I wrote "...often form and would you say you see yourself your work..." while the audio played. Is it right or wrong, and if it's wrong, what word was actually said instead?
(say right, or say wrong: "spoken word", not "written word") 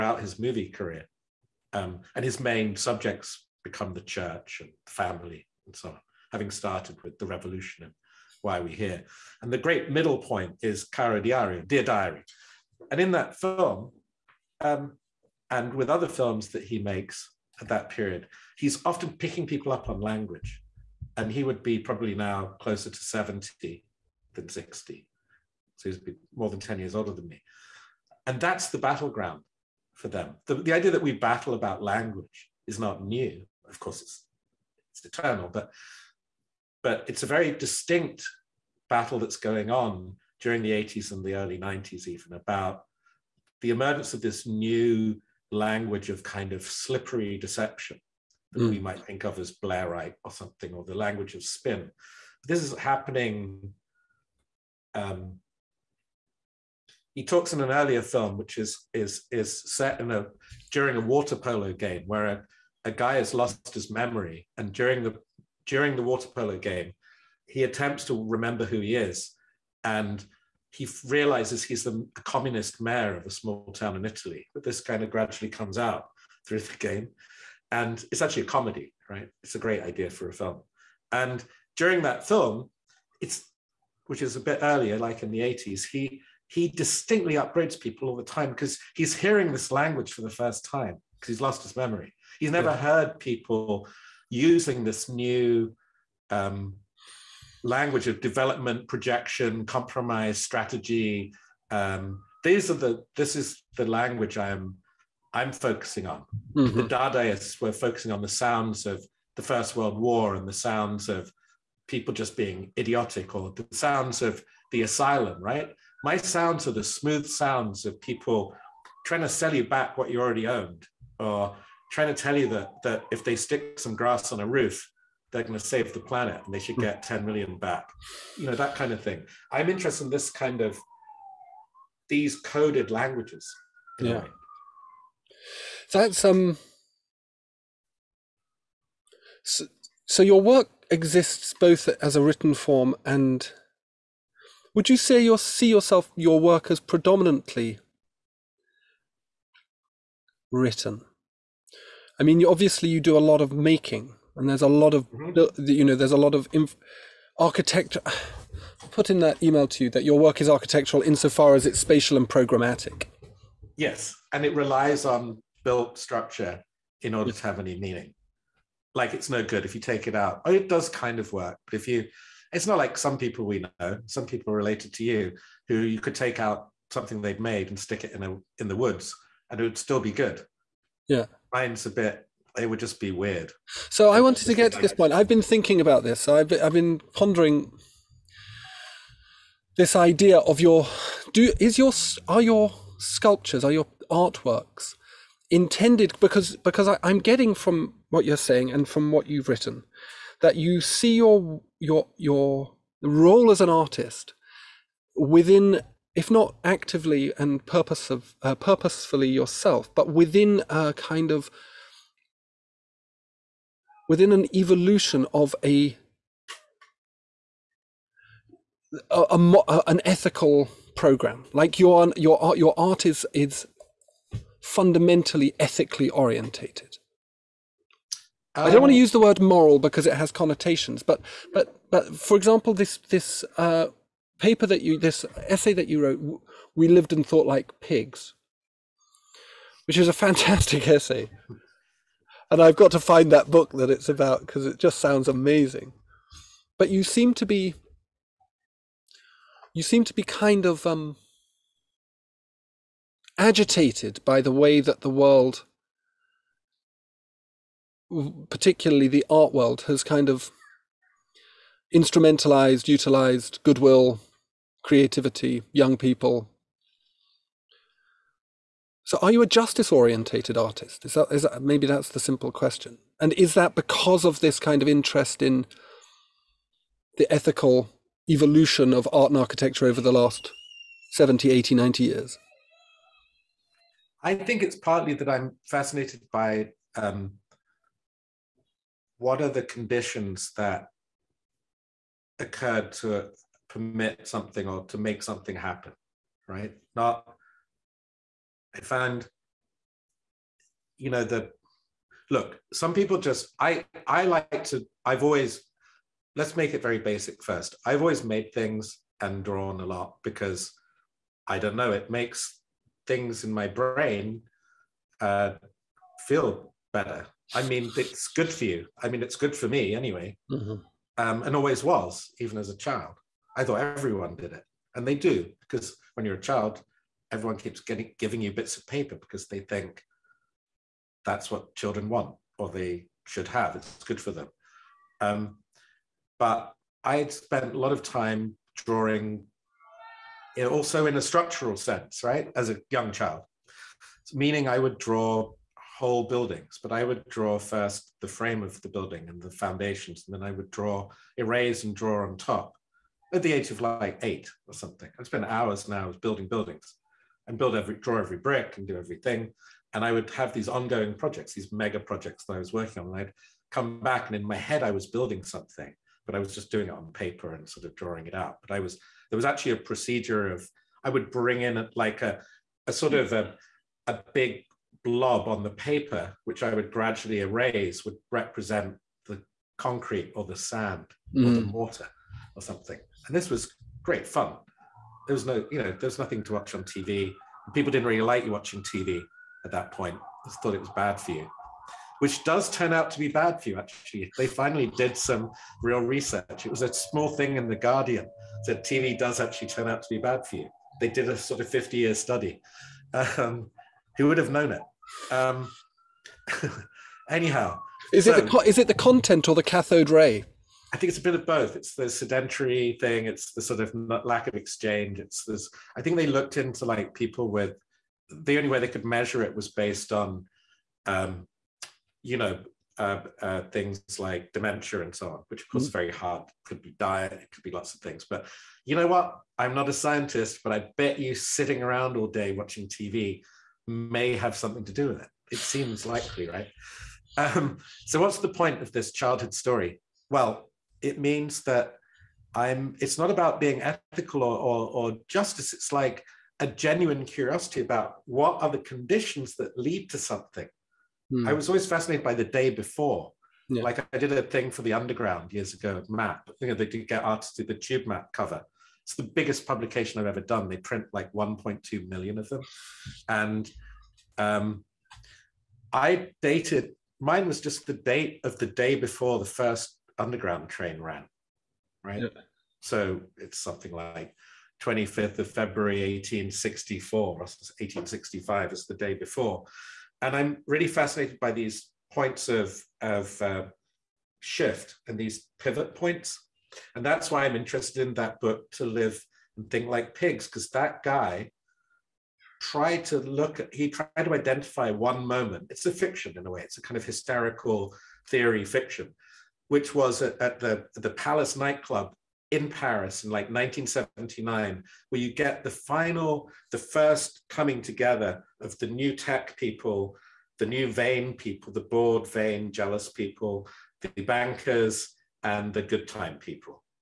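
wrong: "written", not "often".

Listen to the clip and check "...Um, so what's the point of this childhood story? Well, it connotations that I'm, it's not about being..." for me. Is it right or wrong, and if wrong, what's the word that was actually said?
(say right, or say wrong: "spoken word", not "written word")
wrong: "means", not "connotations".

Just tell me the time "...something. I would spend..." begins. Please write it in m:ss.
5:54.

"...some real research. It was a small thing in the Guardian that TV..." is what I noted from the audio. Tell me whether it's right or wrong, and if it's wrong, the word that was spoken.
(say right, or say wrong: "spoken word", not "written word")
right.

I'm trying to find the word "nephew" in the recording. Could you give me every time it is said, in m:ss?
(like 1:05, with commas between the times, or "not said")
not said.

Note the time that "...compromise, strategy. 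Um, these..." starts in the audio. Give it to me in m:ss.
1:39.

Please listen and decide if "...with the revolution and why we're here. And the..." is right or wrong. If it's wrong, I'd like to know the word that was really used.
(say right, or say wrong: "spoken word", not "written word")
right.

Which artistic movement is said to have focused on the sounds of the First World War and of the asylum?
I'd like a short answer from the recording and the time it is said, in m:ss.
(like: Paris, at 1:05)
Dadaists, at 1:46.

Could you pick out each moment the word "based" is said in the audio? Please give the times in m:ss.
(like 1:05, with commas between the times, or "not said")
6:59.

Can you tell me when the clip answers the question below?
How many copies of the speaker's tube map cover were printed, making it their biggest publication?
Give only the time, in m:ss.
7:41.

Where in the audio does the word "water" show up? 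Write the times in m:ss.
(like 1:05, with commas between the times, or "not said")
1:01, 1:06.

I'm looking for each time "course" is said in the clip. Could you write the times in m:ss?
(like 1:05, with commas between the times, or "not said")
0:33, 7:05.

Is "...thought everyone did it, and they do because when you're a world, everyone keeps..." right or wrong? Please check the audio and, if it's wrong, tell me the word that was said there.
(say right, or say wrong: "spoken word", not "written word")
wrong: "child", not "world".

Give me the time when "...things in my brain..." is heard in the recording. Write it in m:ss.
5:13.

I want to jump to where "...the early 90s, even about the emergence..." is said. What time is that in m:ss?
0:41.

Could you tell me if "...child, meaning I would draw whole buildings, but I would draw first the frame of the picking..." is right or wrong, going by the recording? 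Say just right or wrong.
wrong.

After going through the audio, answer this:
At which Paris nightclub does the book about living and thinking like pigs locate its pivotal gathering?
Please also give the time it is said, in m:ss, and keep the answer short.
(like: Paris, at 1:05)
the Palace, at 8:20.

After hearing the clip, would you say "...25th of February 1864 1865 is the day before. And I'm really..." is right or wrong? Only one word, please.
right.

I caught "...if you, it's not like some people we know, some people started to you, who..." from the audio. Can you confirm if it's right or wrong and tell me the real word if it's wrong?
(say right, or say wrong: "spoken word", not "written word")
wrong: "related", not "started".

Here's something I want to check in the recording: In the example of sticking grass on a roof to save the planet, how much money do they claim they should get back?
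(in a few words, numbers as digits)
10 million.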